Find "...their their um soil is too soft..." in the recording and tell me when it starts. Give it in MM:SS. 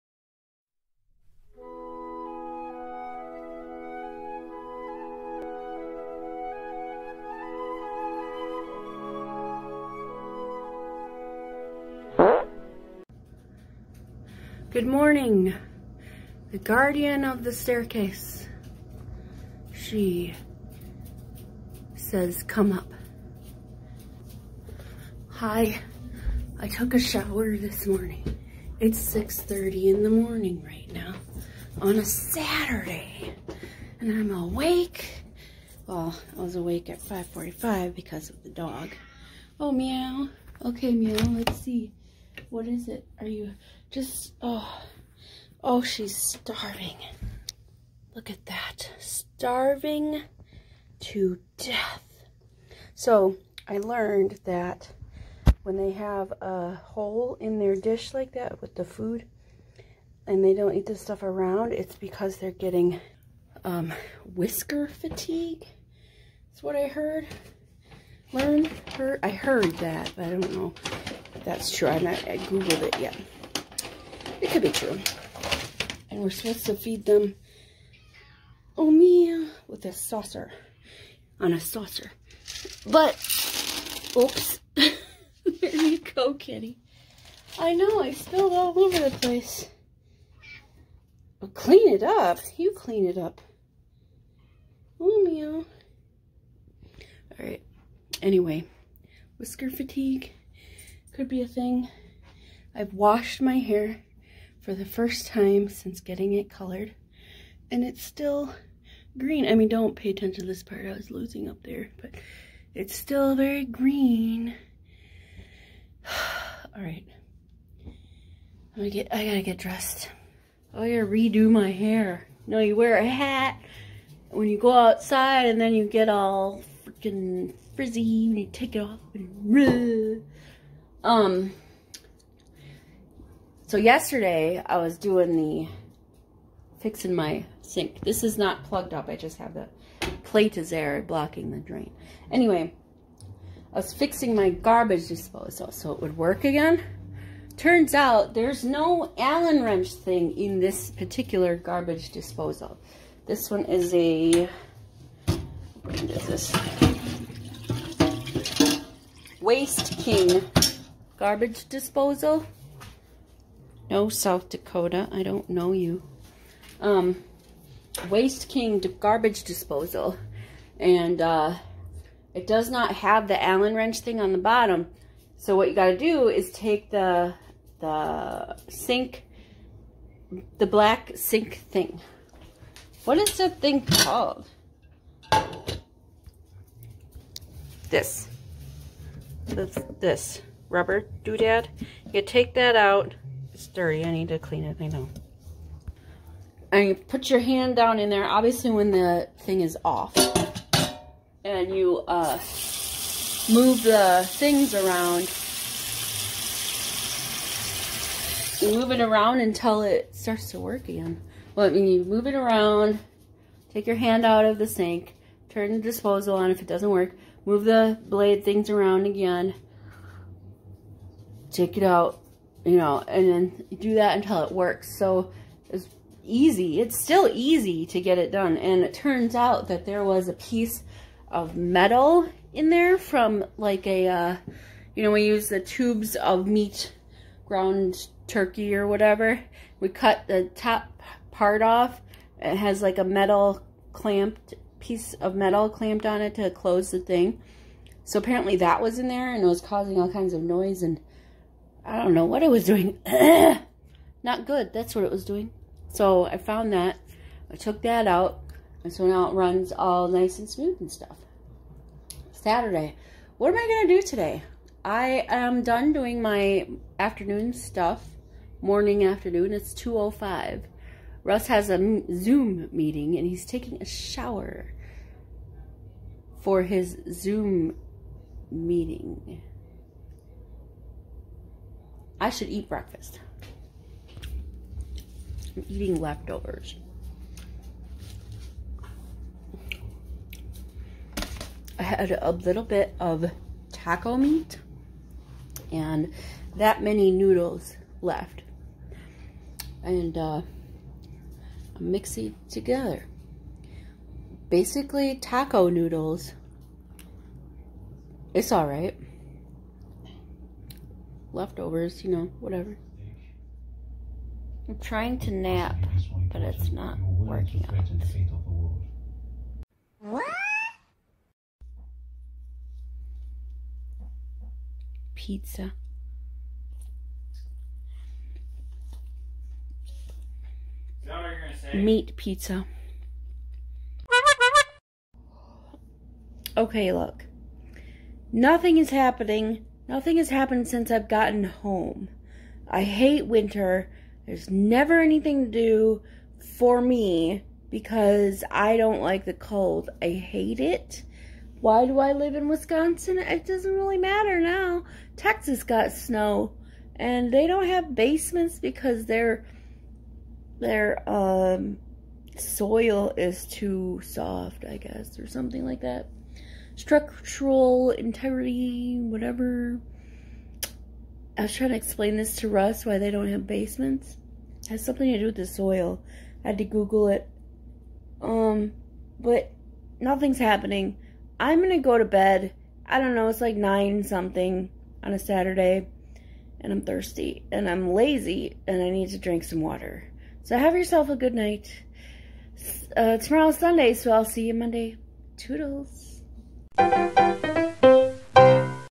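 05:59.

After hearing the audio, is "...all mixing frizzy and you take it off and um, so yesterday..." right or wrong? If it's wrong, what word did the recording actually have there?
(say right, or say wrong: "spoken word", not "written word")
wrong: "freaking", not "mixing".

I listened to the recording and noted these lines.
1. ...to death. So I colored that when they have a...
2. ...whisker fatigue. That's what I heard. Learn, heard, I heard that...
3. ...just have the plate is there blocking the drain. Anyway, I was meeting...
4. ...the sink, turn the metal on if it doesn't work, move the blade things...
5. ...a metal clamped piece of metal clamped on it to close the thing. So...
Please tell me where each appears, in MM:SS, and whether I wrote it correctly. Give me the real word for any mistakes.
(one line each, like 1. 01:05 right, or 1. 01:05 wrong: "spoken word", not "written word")
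1. 00:51 wrong: "learned", not "colored"
2. 01:04 right
3. 02:19 wrong: "fixing", not "meeting"
4. 03:34 wrong: "disposal", not "metal"
5. 04:02 right.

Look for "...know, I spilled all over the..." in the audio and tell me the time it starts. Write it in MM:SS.
01:27.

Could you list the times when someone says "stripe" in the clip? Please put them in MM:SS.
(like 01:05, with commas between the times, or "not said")
not said.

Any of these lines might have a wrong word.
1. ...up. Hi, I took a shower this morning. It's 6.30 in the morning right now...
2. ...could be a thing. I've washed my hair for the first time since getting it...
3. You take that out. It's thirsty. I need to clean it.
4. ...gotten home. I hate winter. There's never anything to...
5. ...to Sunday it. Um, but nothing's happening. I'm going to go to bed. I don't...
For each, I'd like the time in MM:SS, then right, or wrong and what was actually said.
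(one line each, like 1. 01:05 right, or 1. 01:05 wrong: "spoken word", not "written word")
1. 00:22 right
2. 01:41 right
3. 03:12 wrong: "dirty", not "thirsty"
4. 05:41 right
5. 06:16 wrong: "Google", not "Sunday".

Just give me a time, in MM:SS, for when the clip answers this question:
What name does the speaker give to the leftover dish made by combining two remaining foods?
05:05.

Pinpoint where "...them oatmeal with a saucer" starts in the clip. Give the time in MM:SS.
01:17.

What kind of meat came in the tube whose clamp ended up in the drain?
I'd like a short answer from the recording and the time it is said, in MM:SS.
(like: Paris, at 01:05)
ground turkey, at 03:57.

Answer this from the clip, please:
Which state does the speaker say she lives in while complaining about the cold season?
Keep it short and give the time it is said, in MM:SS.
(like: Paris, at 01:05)
Wisconsin, at 05:52.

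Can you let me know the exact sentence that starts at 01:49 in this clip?
I mean, don't pay attention to this part.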